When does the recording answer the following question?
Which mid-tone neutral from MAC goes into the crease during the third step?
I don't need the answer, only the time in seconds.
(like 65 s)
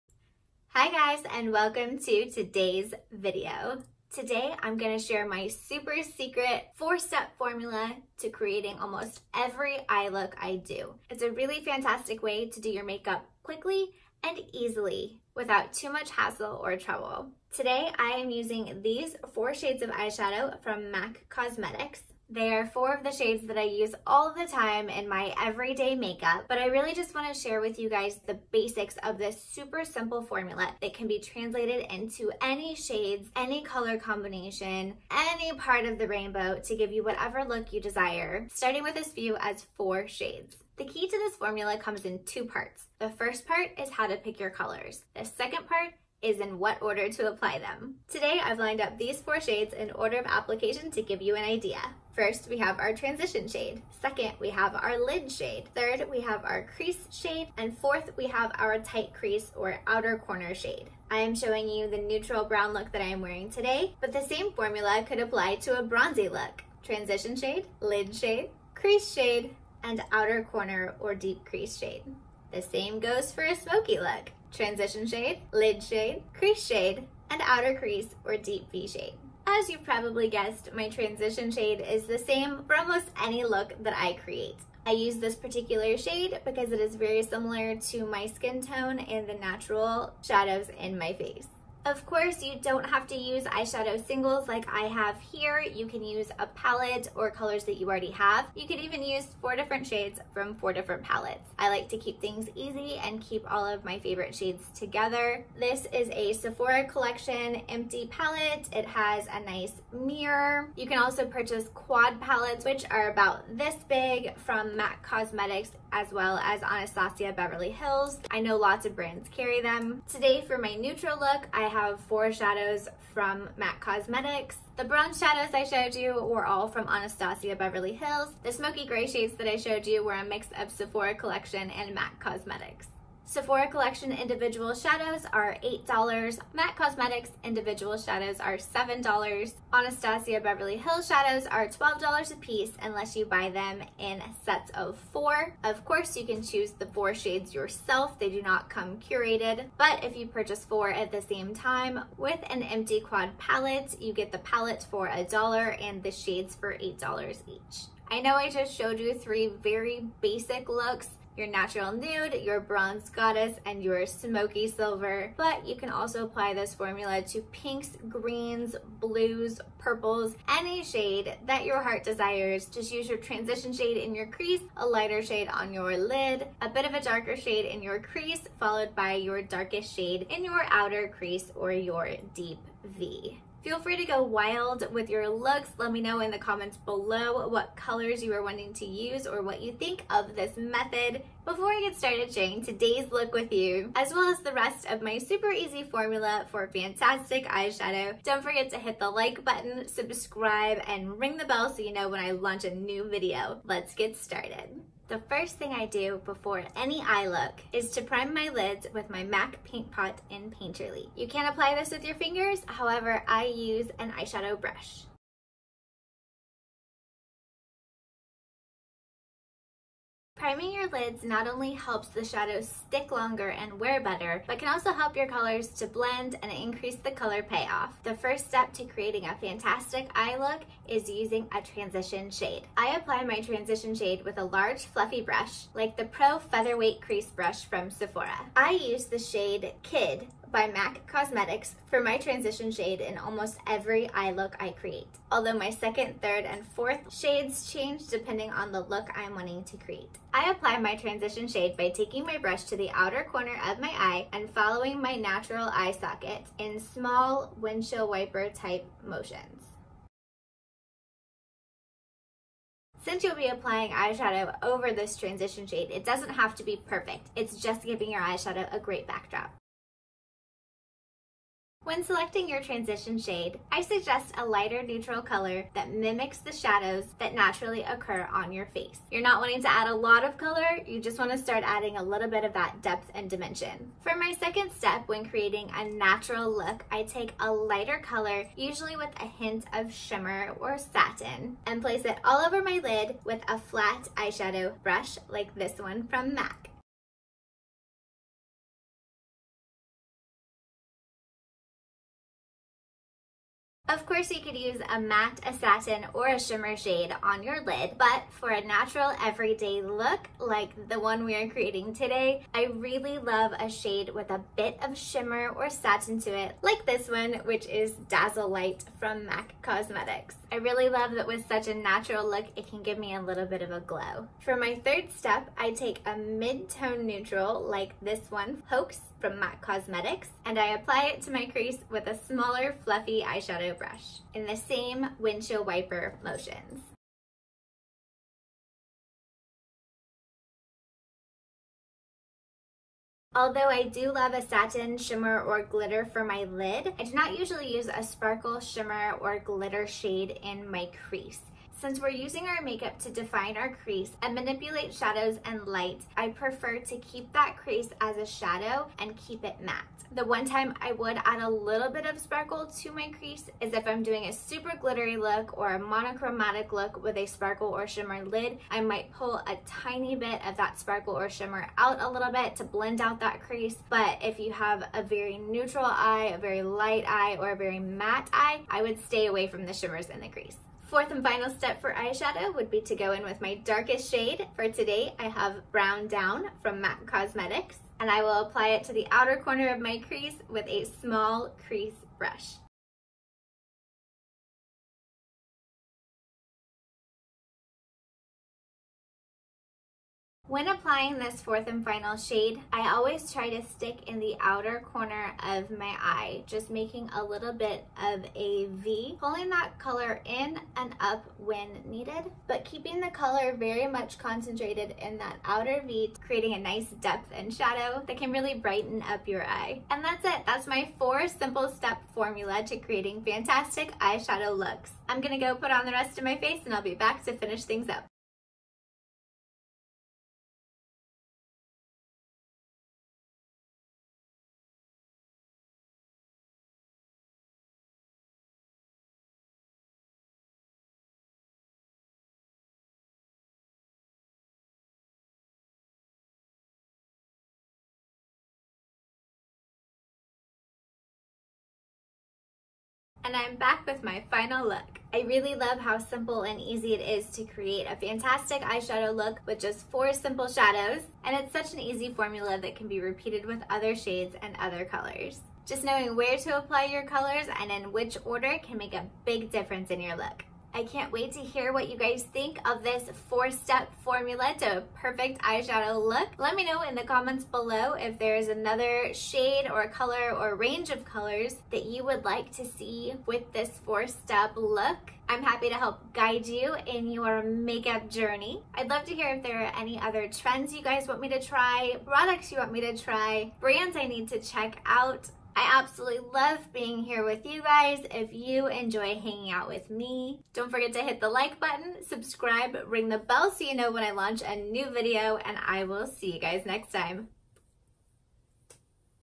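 328 s.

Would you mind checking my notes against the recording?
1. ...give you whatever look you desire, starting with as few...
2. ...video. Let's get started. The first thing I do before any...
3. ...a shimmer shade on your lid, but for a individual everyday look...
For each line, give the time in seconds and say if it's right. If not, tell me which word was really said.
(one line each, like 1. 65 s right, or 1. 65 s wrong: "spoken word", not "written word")
1. 36 s right
2. 203 s right
3. 306 s wrong: "natural", not "individual".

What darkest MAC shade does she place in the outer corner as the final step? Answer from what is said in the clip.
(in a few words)
Brown Down.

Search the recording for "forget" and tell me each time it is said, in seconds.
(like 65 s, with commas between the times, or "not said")
198 s, 500 s.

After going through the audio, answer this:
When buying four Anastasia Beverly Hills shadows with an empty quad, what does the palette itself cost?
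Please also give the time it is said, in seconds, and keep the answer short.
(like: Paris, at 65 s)
$1, at 155 s.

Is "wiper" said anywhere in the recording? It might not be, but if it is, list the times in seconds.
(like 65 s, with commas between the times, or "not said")
258 s, 335 s.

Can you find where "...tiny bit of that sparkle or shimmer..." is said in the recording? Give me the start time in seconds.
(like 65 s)
369 s.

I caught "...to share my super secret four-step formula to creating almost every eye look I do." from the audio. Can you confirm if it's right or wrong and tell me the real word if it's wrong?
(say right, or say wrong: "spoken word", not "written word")
right.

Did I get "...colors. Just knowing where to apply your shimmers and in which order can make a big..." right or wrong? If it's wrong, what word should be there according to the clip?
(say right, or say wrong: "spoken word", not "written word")
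wrong: "colors", not "shimmers".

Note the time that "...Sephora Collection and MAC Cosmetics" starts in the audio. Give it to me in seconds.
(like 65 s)
130 s.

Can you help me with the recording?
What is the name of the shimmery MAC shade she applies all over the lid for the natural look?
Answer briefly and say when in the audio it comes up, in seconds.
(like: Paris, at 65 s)
Dazzle Light, at 318 s.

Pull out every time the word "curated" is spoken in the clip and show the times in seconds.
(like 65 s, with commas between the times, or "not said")
148 s.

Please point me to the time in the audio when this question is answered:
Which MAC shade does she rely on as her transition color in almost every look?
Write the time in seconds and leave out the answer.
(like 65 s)
239 s.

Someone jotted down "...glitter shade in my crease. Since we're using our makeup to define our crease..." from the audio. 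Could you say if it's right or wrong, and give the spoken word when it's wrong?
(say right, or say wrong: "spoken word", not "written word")
right.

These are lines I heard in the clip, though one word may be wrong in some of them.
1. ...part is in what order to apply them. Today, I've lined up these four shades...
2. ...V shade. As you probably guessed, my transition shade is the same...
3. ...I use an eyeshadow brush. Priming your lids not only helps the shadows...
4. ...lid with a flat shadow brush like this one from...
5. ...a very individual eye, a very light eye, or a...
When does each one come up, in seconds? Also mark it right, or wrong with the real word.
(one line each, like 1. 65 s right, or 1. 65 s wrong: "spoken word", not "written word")
1. 45 s right
2. 78 s right
3. 213 s right
4. 292 s wrong: "eyeshadow", not "shadow"
5. 374 s wrong: "neutral", not "individual".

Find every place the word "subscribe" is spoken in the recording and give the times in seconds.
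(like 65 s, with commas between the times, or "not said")
199 s, 502 s.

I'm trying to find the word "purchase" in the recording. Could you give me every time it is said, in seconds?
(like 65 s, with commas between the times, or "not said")
111 s, 150 s.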